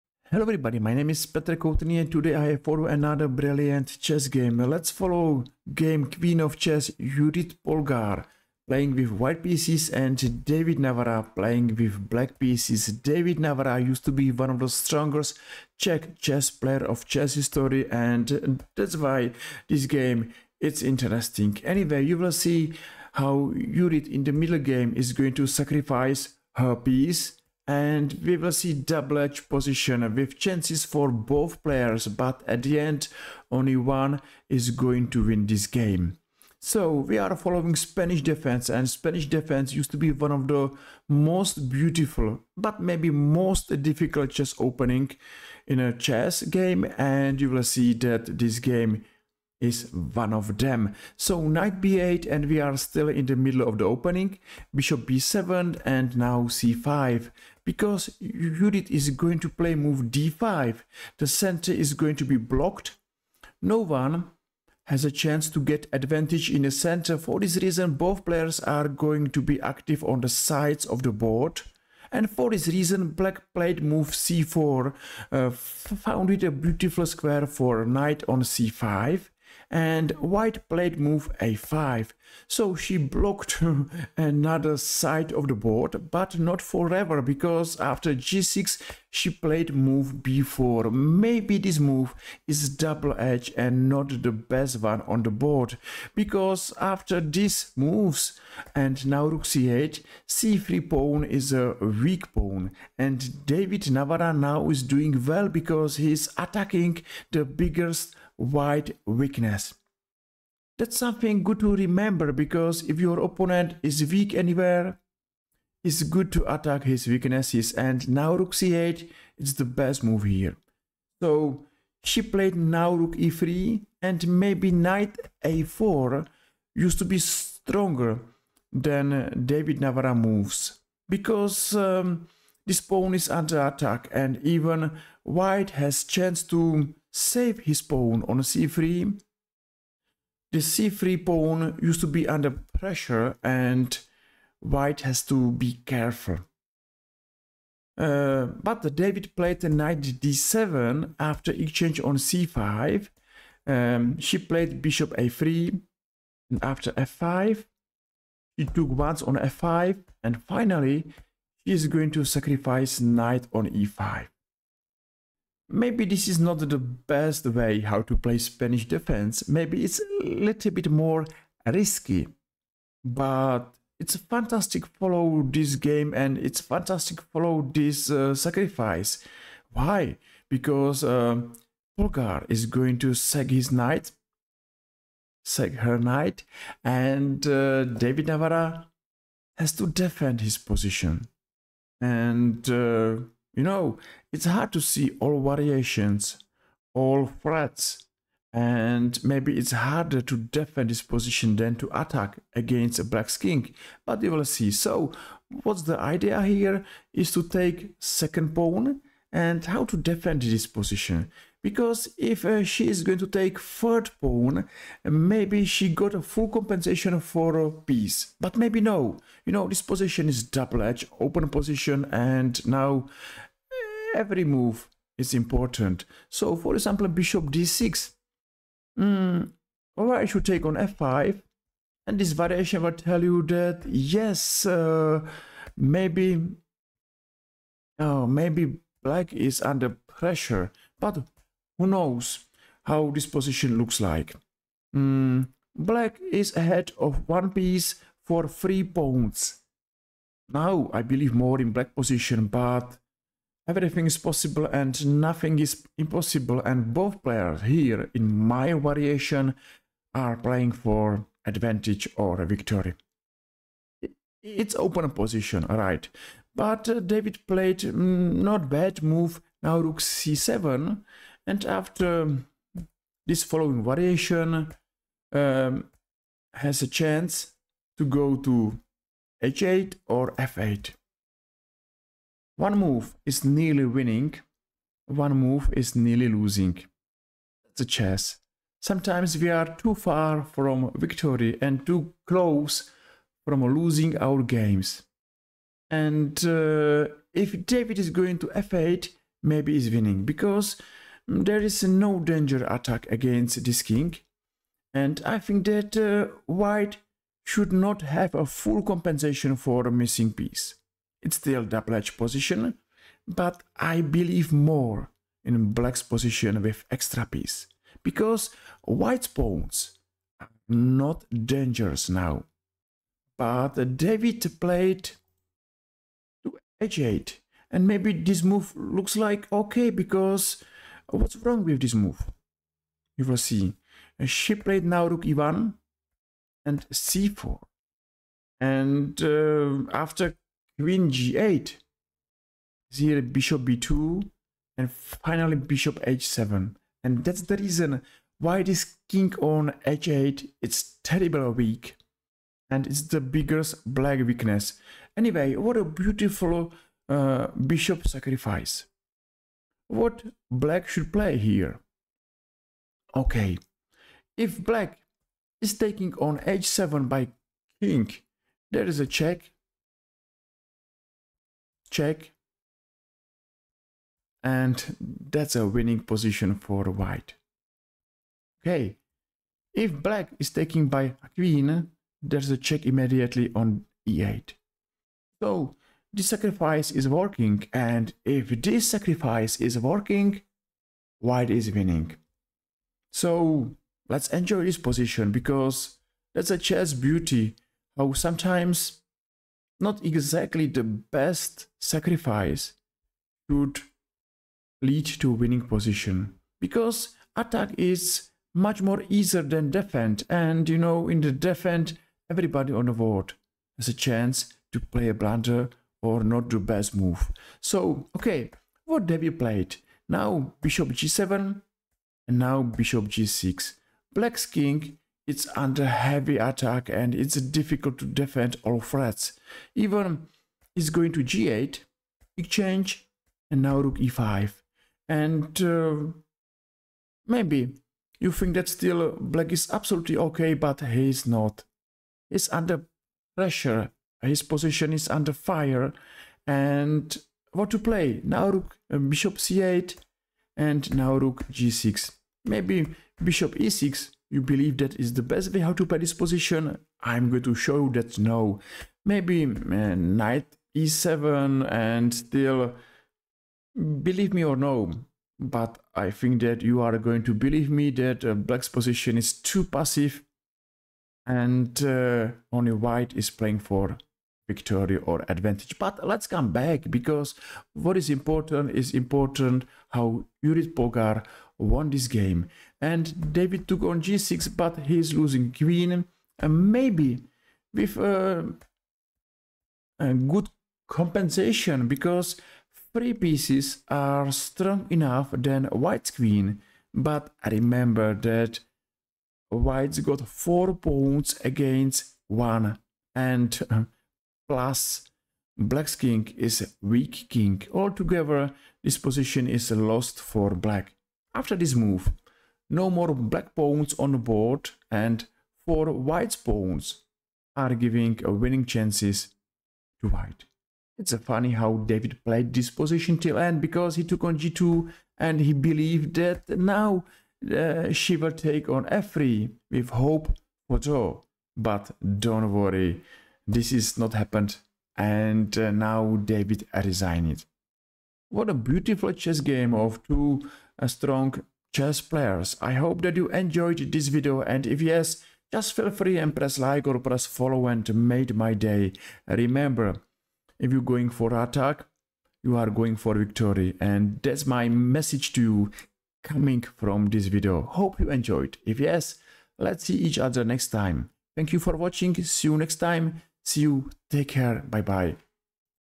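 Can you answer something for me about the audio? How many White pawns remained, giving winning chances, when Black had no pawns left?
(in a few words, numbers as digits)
4.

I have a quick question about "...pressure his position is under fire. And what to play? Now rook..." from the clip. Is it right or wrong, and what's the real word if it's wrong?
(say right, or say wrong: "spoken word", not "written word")
right.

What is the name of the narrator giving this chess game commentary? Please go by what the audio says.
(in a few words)
Petr Koutný.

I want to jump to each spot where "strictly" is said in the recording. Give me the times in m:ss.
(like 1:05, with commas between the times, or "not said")
not said.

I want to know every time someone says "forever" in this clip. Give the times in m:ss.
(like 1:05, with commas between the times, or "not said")
1:26.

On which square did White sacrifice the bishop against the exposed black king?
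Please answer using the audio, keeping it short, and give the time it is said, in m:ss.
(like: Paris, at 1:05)
h7, at 5:45.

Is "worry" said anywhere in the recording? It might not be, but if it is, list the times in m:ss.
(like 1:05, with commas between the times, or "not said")
8:52.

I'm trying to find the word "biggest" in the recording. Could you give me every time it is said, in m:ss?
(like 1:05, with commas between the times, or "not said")
1:47, 5:53.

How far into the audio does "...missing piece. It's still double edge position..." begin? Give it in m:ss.
5:09.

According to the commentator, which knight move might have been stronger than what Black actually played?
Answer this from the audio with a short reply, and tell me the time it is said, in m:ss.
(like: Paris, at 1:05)
knight a4, at 2:04.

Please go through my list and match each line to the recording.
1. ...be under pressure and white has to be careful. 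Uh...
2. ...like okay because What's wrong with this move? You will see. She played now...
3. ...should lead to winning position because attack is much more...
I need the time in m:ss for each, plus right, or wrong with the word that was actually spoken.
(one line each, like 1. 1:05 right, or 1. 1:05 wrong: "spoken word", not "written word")
1. 2:22 right
2. 5:29 right
3. 6:43 right.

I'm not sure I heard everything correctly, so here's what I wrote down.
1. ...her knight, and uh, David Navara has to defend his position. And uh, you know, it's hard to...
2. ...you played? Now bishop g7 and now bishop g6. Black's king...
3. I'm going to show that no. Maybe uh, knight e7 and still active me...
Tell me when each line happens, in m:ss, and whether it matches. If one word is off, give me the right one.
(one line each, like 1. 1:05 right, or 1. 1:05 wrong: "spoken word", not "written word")
1. 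3:05 right
2. 6:59 right
3. 7:37 wrong: "believe", not "active".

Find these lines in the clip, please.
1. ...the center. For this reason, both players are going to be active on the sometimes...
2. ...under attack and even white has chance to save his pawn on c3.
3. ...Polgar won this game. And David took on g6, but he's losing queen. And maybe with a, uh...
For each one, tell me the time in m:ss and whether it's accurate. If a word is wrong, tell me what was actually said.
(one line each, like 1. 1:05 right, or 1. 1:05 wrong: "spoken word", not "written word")
1. 1:06 wrong: "sides", not "sometimes"
2. 2:13 right
3. 8:00 right.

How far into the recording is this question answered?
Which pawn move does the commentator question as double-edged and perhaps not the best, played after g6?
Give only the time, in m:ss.
1:30.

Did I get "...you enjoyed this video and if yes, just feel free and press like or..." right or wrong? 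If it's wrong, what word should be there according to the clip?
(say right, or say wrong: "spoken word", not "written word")
right.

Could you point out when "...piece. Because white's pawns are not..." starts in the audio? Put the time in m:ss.
5:17.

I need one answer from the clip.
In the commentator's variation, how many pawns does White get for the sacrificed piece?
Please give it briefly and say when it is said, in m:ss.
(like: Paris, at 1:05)
3, at 4:08.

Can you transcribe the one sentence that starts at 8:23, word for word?
And uh, plus black's king is weak king.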